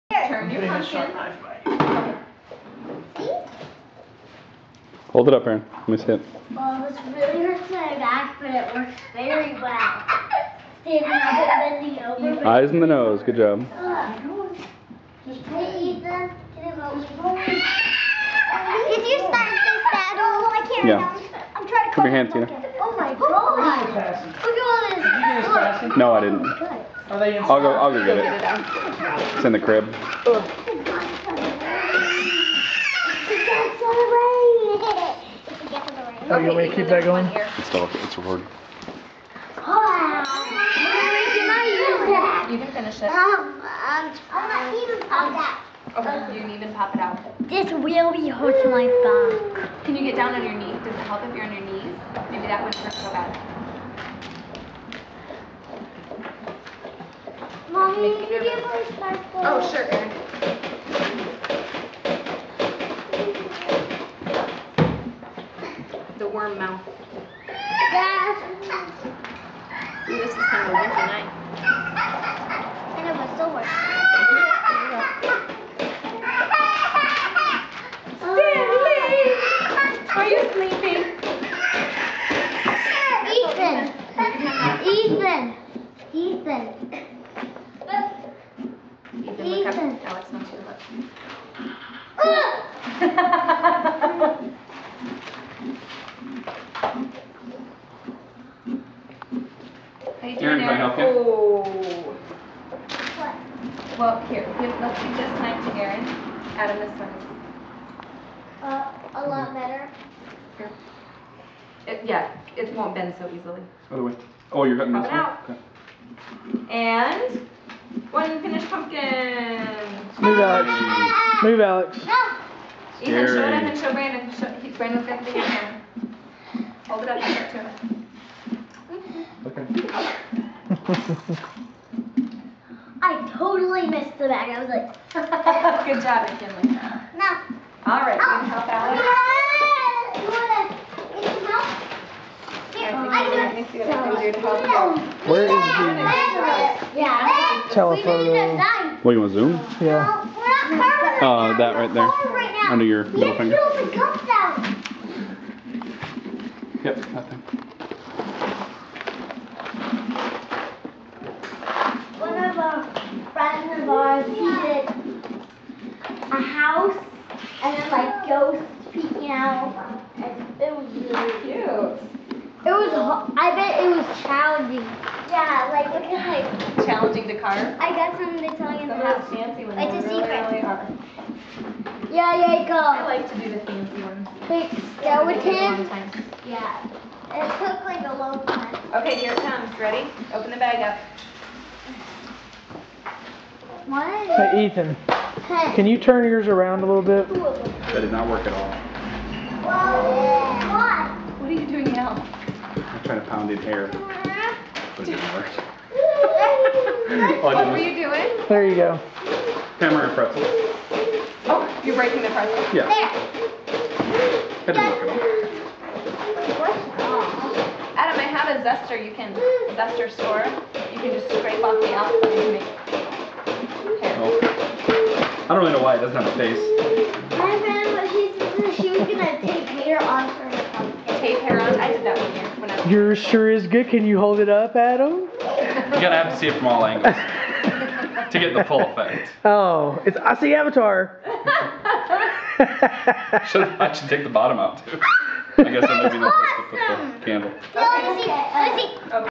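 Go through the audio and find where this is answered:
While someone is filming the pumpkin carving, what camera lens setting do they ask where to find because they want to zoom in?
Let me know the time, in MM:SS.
02:27.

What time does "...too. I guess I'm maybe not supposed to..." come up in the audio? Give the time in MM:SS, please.
04:04.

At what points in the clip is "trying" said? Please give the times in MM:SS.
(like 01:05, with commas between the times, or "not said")
00:21, 03:23.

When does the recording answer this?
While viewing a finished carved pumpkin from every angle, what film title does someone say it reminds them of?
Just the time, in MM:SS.
04:00.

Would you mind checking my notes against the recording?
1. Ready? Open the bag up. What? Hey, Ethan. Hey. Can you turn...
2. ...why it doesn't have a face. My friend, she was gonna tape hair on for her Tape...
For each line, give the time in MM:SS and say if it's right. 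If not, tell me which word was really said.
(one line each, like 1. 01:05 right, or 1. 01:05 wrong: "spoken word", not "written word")
1. 03:09 right
2. 03:45 right.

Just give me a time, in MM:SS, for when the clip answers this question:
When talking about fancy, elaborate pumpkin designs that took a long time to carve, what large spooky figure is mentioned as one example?
03:04.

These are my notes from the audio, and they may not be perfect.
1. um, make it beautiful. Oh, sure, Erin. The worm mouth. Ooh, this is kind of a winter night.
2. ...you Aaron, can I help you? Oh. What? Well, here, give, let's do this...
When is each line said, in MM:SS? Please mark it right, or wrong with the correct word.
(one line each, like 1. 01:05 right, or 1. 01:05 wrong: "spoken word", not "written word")
1. 00:57 right
2. 01:40 right.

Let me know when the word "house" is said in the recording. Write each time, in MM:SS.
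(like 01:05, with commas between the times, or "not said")
02:46, 02:59.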